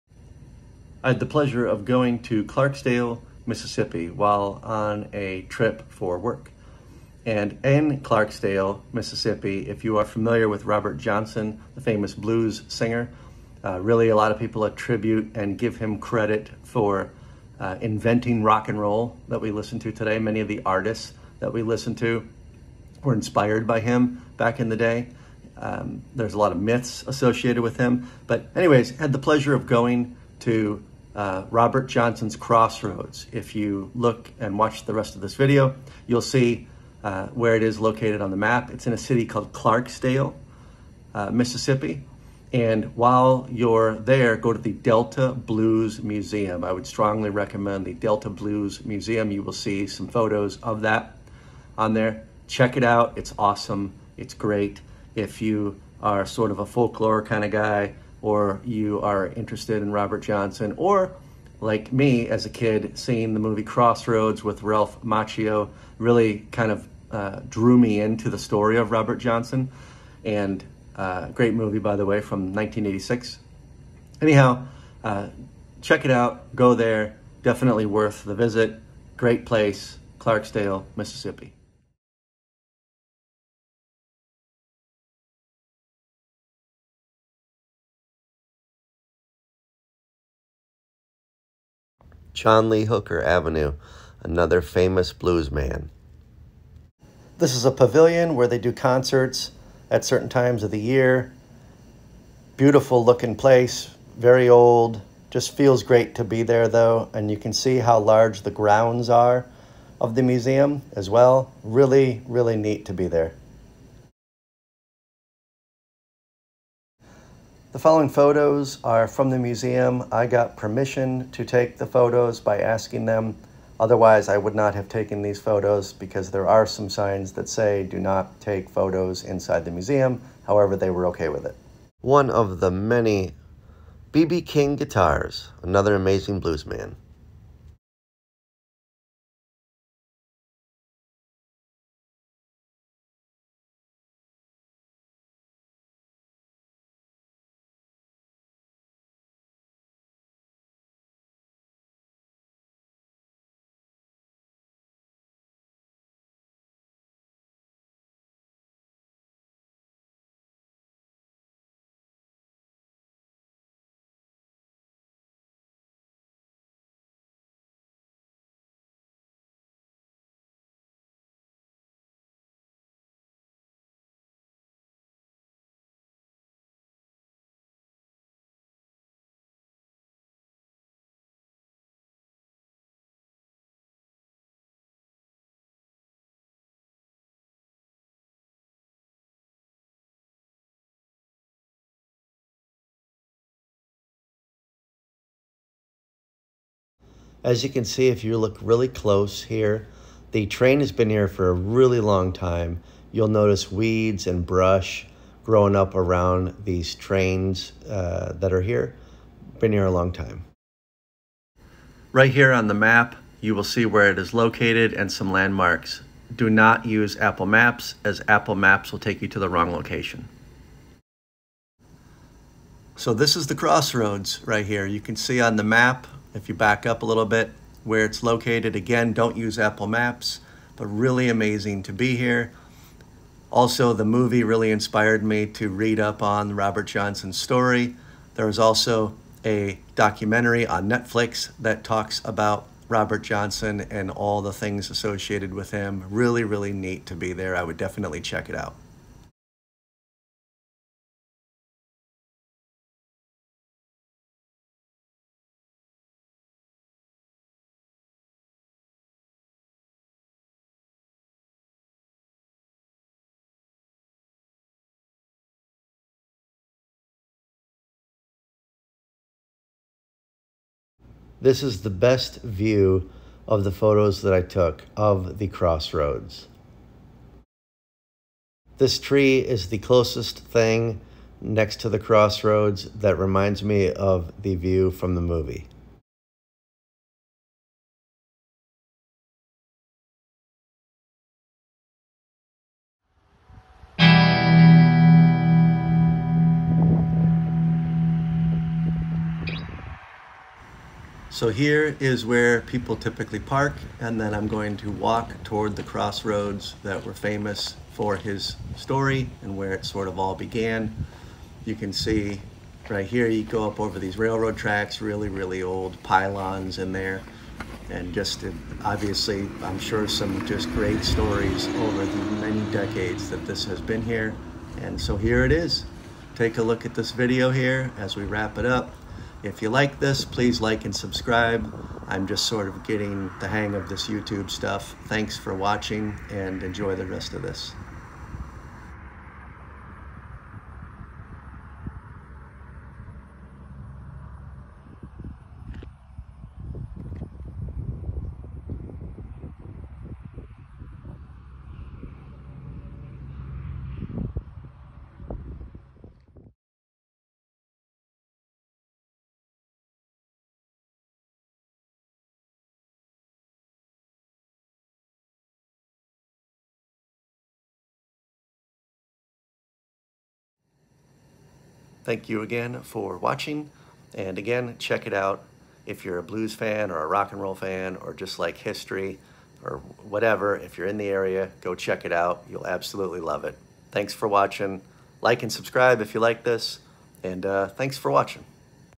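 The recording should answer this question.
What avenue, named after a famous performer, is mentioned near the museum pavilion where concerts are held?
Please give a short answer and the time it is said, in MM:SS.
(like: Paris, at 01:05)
John Lee Hooker Avenue, at 01:32.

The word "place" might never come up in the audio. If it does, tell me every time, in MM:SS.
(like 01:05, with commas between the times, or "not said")
01:19, 01:43.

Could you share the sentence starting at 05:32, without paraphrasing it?
I'm just sort of getting the hang of this YouTube stuff.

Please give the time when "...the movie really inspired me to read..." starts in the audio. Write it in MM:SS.
03:53.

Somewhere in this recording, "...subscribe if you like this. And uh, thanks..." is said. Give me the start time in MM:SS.
06:25.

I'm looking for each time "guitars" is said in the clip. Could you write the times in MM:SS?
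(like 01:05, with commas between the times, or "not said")
02:14.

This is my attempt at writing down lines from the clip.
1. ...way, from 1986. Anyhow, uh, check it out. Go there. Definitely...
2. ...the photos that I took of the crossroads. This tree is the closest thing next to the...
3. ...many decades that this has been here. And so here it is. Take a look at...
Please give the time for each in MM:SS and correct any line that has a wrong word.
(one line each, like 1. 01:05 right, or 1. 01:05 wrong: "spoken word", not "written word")
1. 01:12 right
2. 04:33 right
3. 05:22 right.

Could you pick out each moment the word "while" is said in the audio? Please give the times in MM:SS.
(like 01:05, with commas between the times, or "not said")
00:04, 00:42.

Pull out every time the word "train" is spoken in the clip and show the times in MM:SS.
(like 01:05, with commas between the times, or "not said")
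03:20, 03:26.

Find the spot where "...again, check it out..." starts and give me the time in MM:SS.
06:14.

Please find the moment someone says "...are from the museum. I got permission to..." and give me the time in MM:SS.
01:58.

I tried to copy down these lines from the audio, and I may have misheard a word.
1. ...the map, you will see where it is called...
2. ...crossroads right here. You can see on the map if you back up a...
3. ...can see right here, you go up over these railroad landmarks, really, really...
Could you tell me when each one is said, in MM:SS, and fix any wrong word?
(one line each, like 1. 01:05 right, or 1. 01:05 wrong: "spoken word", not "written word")
1. 03:32 wrong: "located", not "called"
2. 03:43 right
3. 05:11 wrong: "tracks", not "landmarks".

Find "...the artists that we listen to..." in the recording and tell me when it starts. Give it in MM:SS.
00:20.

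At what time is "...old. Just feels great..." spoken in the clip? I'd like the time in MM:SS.
01:44.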